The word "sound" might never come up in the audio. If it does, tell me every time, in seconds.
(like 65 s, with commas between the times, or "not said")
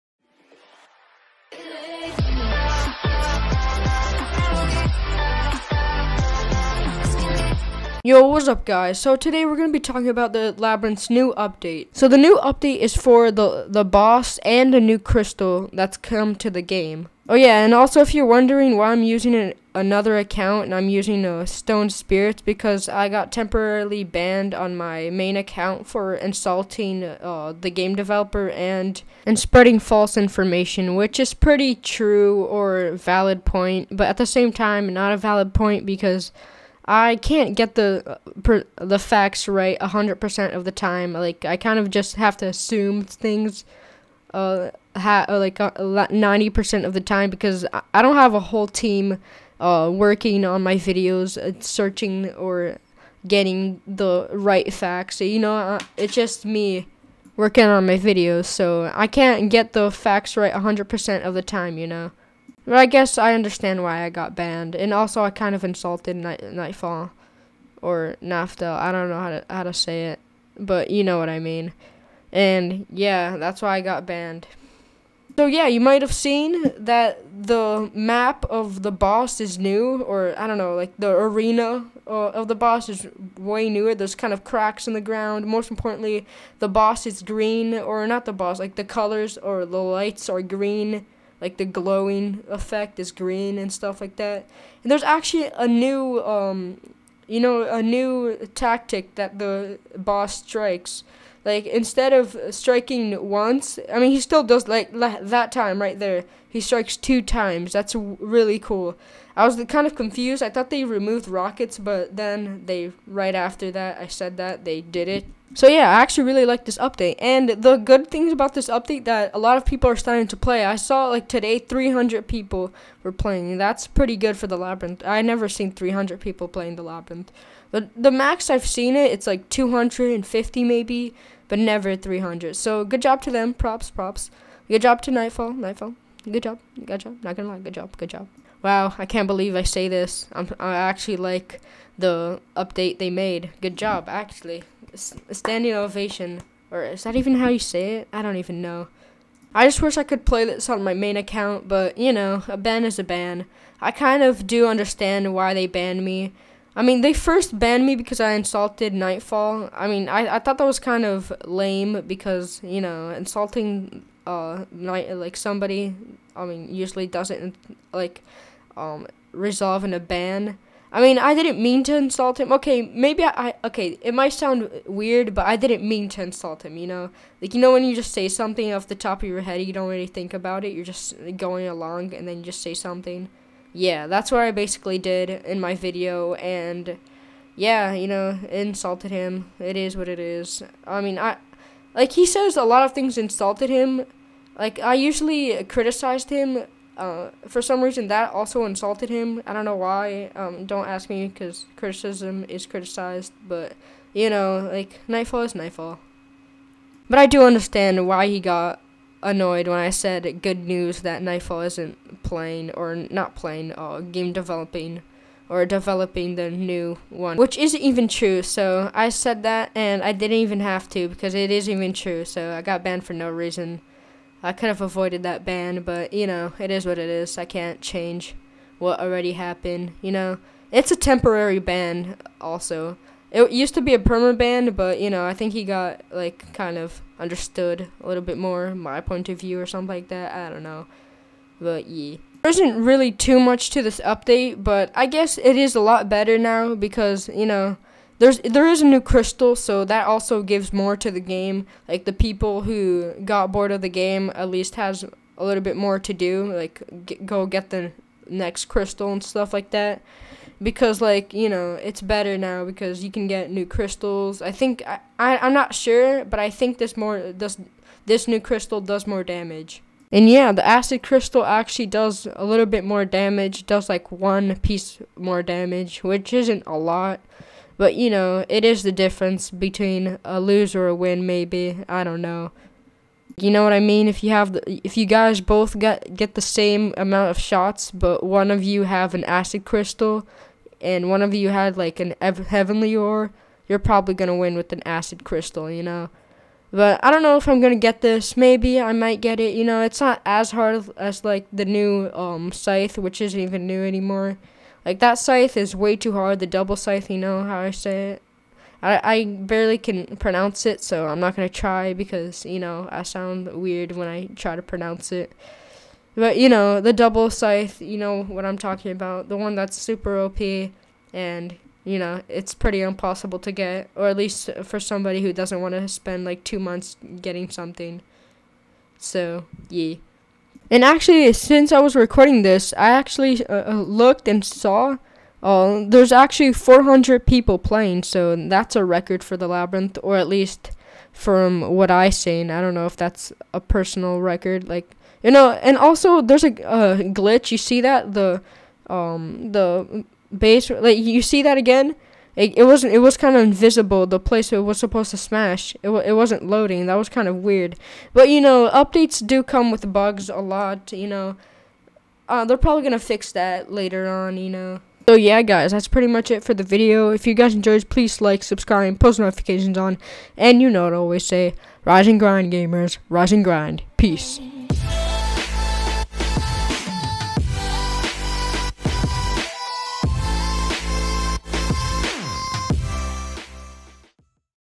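174 s, 313 s.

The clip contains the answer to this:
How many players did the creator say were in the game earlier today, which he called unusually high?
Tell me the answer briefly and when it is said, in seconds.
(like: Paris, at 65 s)
300, at 121 s.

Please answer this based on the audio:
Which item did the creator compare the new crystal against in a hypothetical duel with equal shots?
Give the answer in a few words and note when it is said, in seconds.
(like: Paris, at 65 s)
heavenly ore, at 292 s.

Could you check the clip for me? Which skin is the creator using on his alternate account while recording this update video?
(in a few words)
stone spirit.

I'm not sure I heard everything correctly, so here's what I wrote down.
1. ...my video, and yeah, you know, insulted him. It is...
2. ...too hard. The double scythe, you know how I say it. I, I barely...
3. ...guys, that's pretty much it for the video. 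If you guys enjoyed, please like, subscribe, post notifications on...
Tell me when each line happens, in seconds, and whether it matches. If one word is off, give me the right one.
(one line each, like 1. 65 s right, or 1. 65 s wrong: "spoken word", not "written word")
1. 185 s right
2. 305 s right
3. 365 s right.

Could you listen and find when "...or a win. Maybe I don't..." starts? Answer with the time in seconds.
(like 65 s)
280 s.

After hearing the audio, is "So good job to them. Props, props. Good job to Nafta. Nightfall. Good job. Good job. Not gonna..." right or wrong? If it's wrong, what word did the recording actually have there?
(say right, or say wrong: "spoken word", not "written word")
wrong: "Nightfall", not "Nafta".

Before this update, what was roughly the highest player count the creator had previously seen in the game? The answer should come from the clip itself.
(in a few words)
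250.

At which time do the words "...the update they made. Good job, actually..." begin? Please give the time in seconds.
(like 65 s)
141 s.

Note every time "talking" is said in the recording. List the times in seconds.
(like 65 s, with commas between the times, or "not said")
9 s, 318 s.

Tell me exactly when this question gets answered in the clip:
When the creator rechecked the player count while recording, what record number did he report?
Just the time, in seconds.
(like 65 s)
336 s.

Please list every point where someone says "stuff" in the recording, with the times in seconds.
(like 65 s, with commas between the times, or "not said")
93 s, 259 s.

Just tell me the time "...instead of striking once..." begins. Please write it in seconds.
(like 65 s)
101 s.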